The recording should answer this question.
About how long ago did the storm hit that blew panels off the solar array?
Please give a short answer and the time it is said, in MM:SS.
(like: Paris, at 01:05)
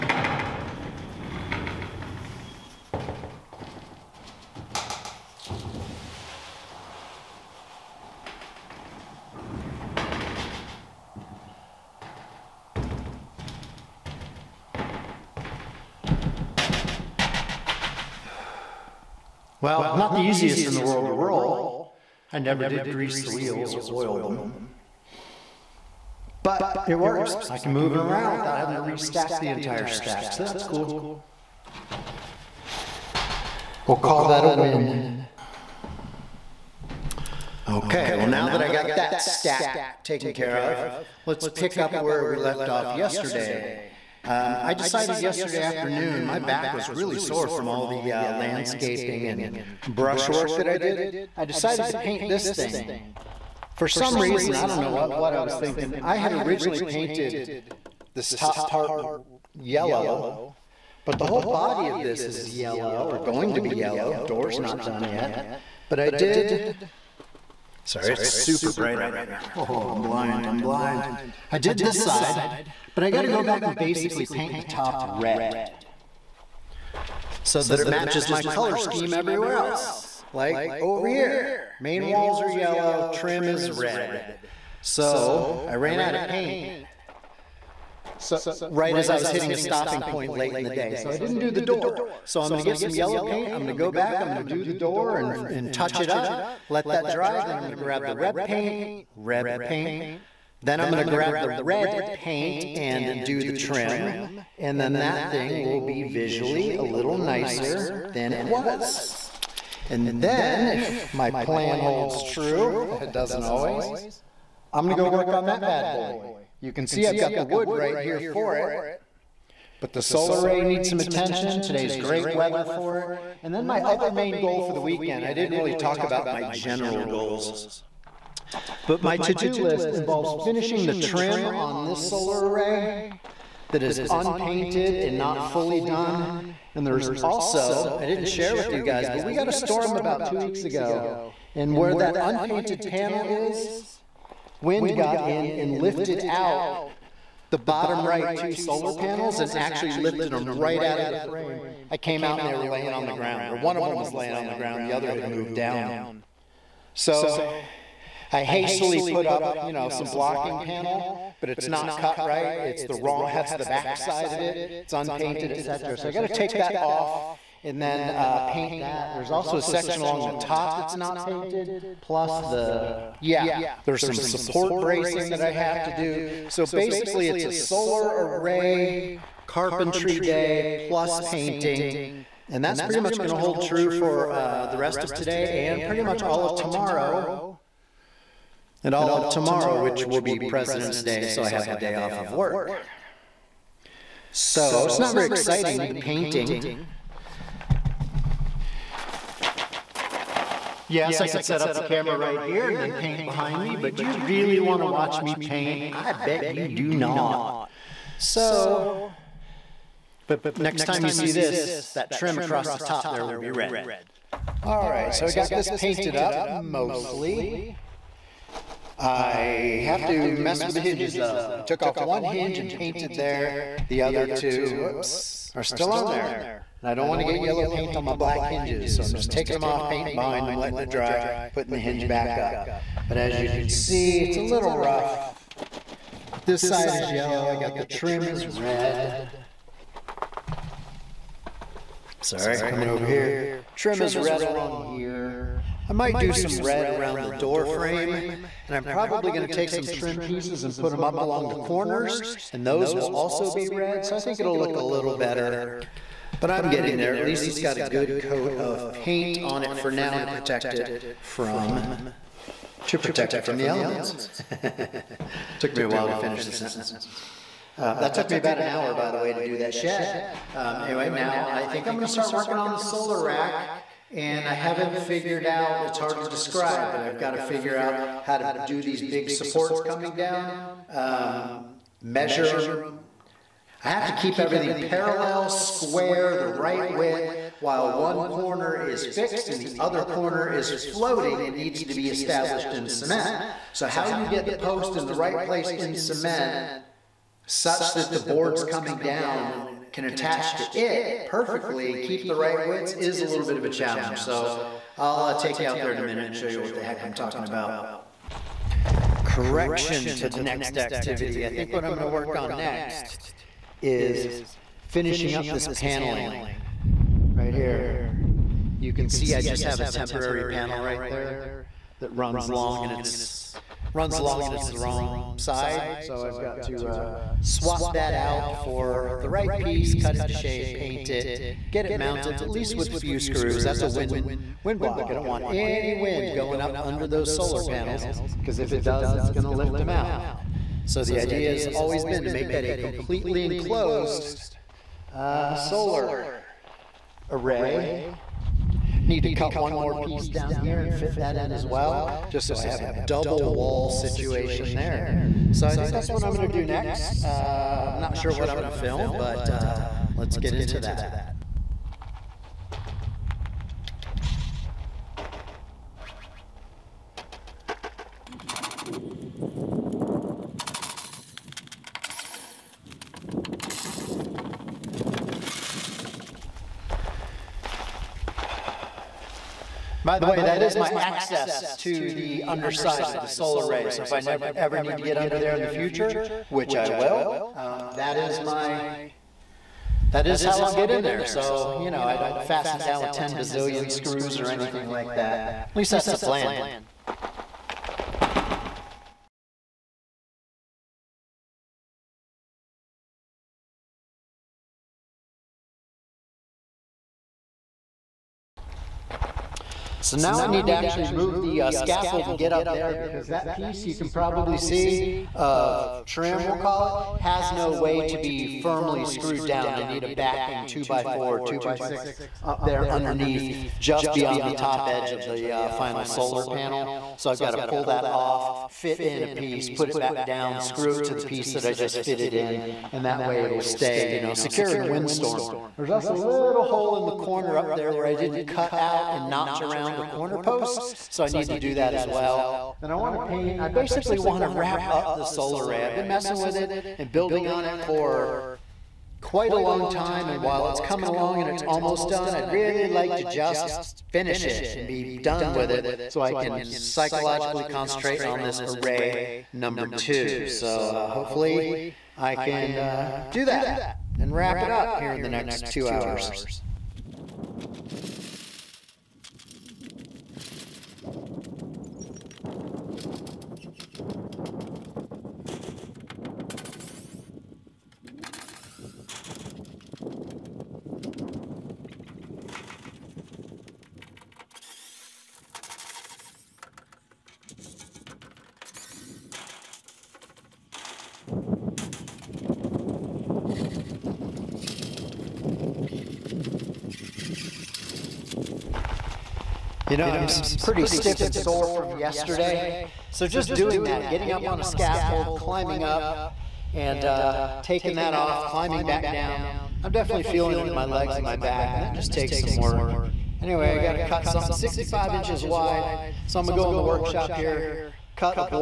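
2 weeks, at 02:20.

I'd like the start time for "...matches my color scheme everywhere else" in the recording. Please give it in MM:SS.
01:17.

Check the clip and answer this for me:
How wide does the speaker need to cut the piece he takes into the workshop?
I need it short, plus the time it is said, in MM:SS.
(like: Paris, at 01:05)
65 inches, at 08:34.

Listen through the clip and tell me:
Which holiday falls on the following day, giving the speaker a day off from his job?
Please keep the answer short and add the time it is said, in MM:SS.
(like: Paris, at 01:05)
President's Day, at 03:10.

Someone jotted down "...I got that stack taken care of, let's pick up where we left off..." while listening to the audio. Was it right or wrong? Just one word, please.
right.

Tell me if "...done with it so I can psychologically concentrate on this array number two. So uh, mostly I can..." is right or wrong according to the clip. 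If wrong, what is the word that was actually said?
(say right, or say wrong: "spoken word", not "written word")
wrong: "hopefully", not "mostly".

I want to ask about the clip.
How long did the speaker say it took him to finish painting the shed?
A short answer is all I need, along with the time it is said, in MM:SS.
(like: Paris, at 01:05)
About an hour, at 04:28.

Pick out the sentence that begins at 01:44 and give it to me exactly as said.
And then that thing will be visually a little nicer than it was.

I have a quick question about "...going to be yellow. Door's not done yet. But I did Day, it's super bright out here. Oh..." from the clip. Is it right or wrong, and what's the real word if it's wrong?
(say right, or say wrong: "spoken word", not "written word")
wrong: "Sorry", not "Day".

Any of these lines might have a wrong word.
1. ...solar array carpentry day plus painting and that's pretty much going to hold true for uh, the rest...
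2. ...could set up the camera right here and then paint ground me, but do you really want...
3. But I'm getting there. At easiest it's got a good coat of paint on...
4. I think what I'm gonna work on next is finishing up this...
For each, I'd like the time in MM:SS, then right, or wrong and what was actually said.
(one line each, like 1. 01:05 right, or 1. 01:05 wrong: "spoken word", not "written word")
1. 02:57 right
2. 03:21 wrong: "behind", not "ground"
3. 04:16 wrong: "least", not "easiest"
4. 05:11 right.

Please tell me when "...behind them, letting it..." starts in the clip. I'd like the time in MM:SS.
03:50.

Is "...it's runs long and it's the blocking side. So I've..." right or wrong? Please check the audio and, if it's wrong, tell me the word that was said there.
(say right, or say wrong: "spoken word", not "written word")
wrong: "wrong", not "blocking".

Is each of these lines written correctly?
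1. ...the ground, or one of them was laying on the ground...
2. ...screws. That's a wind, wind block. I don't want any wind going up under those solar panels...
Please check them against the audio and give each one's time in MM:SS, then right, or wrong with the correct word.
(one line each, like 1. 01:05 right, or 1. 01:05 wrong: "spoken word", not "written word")
1. 02:33 right
2. 05:33 right.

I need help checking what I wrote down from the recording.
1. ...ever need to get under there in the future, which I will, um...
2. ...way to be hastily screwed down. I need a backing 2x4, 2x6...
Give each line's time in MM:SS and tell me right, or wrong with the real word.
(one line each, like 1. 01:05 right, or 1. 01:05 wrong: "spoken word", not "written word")
1. 06:24 right
2. 06:57 wrong: "firmly", not "hastily".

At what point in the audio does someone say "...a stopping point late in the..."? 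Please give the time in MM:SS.
01:29.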